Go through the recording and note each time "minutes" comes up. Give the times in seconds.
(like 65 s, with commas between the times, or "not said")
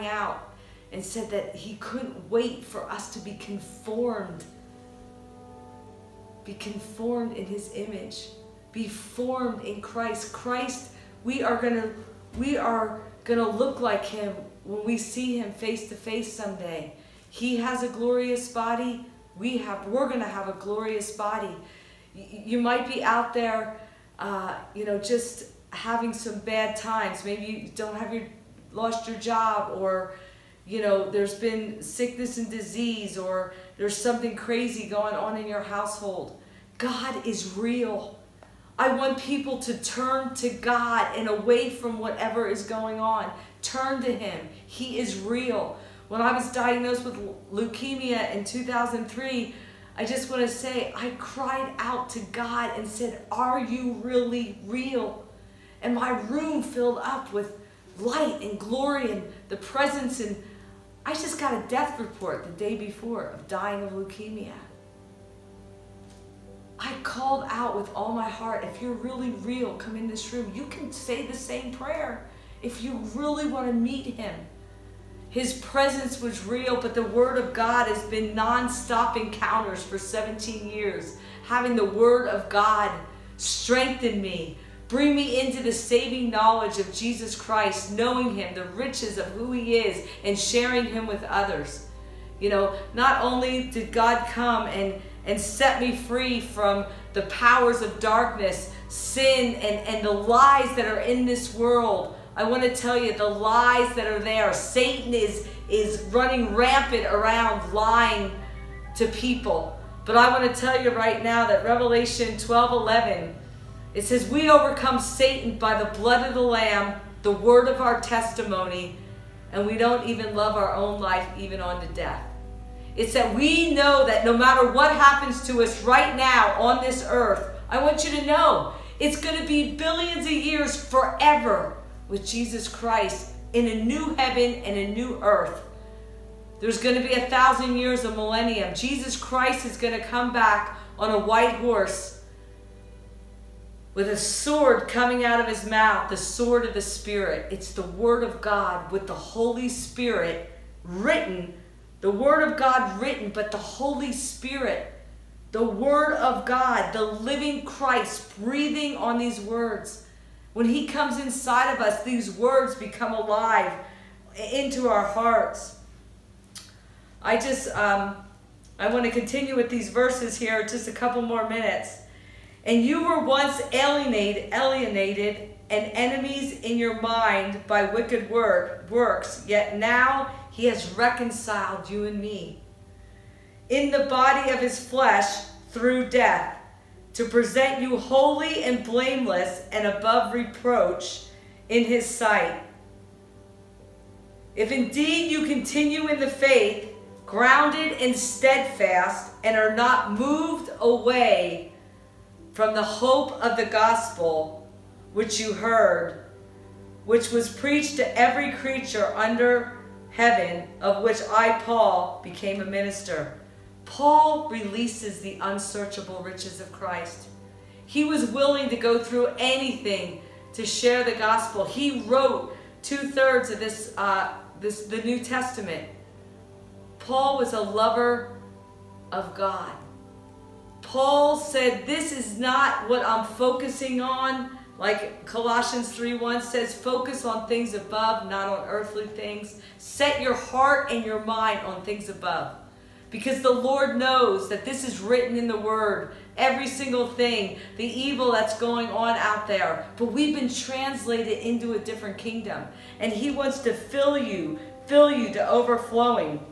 171 s.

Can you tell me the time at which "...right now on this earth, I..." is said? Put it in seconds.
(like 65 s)
125 s.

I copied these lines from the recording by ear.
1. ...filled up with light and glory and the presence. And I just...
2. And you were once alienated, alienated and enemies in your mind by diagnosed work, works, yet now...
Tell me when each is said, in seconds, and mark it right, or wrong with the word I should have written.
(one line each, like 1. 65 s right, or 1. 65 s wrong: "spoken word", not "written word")
1. 56 s right
2. 172 s wrong: "wicked", not "diagnosed".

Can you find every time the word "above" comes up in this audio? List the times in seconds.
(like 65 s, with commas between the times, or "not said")
189 s, 237 s, 242 s.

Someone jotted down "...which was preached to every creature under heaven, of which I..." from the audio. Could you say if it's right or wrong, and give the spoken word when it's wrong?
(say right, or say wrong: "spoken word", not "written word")
right.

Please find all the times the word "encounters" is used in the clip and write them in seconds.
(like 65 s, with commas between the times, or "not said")
79 s.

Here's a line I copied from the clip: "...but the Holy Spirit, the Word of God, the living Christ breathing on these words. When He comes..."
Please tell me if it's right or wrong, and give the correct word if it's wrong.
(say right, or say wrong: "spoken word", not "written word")
right.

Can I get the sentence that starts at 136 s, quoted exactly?
There's going to be a thousand years of millennium.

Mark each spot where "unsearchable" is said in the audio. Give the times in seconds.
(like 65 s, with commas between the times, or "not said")
215 s.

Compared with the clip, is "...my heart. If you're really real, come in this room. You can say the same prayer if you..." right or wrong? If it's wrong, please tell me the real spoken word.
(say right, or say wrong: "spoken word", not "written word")
right.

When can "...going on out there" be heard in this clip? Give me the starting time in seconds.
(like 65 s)
248 s.